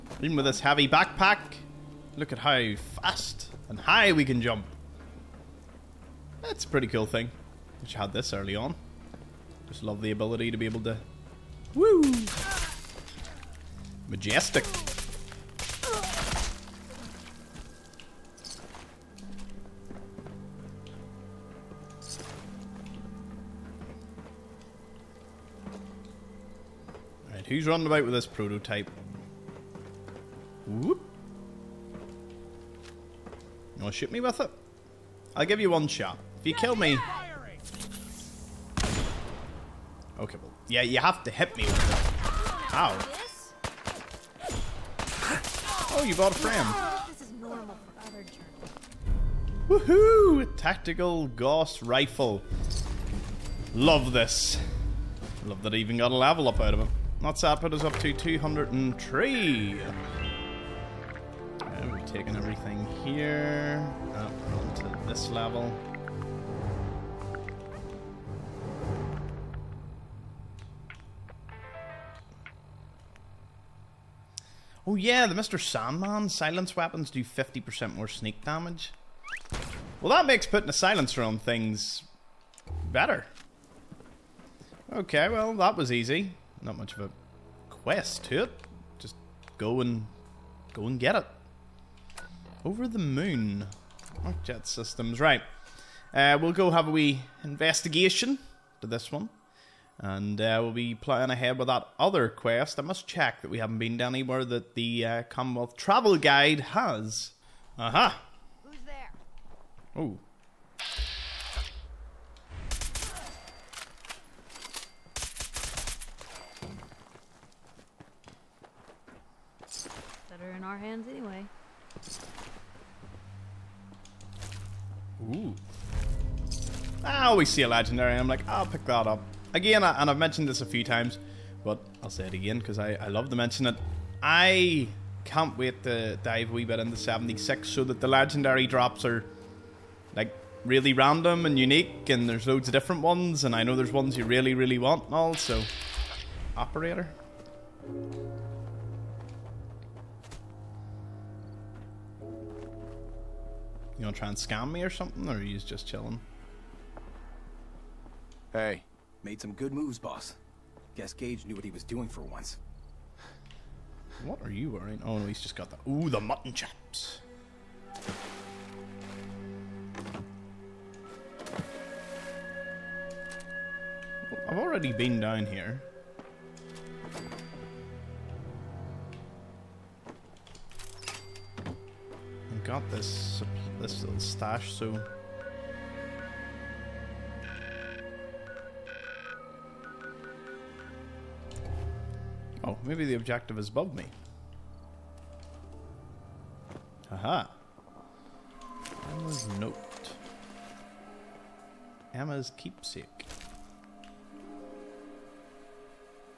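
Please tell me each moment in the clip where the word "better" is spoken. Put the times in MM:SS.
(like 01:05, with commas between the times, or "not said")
01:22, 02:00.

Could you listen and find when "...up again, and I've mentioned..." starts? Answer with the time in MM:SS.
02:09.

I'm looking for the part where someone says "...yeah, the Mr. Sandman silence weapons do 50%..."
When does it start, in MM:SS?
01:14.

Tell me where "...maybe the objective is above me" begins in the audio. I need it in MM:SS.
03:12.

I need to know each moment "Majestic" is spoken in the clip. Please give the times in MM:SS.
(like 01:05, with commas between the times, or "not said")
00:14.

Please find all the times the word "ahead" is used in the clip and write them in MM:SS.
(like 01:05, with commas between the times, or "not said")
01:41.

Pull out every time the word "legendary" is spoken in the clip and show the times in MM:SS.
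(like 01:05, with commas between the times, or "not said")
02:07, 02:18.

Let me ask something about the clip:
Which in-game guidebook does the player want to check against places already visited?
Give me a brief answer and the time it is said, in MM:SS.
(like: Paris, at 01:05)
Commonwealth Travel Guide, at 01:45.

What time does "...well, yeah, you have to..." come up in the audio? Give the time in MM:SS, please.
00:40.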